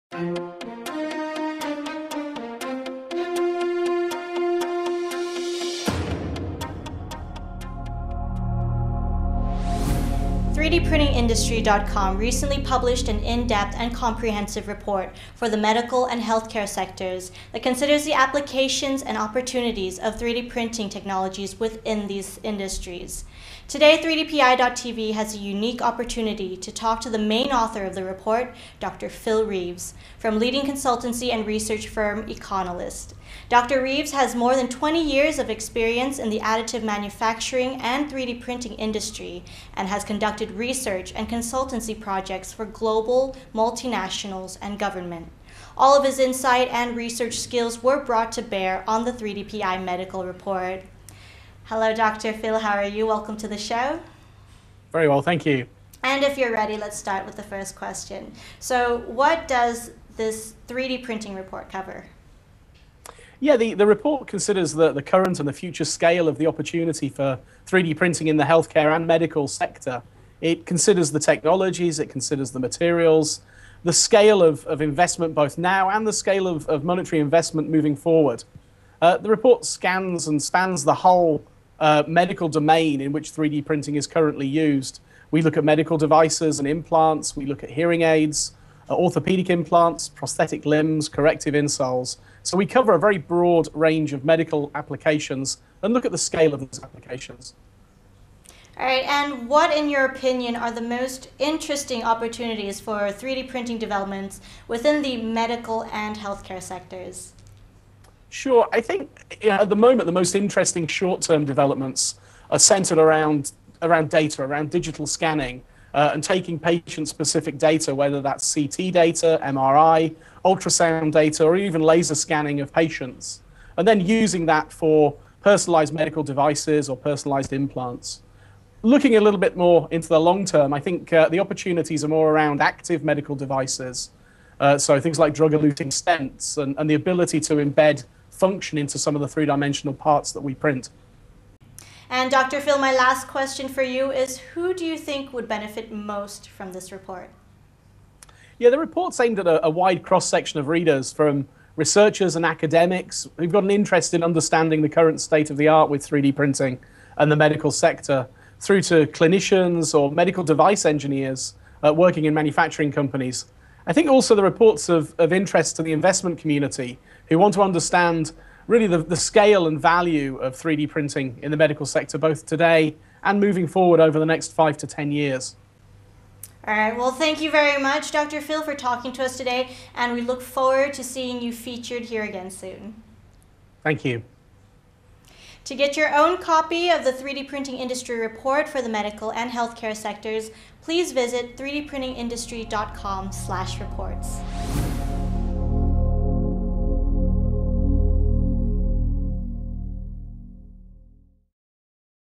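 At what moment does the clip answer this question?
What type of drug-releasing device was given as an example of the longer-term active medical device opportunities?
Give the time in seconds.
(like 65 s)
135 s.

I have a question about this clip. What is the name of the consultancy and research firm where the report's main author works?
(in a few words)
Econolyst.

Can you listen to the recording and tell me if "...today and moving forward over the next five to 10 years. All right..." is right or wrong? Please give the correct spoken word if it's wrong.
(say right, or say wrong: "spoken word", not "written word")
right.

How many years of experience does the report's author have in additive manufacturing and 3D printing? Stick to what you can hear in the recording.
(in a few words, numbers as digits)
More than 20.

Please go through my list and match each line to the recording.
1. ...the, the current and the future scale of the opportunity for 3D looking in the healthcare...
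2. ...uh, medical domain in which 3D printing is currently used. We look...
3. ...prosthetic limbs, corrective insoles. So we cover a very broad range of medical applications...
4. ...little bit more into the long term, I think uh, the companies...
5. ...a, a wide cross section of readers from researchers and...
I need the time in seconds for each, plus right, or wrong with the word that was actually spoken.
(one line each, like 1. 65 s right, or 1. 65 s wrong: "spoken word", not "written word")
1. 64 s wrong: "printing", not "looking"
2. 81 s right
3. 90 s right
4. 129 s wrong: "opportunities", not "companies"
5. 149 s right.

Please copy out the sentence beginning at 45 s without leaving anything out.
All of his insight and research skills were brought to bear on the 3DPI medical report.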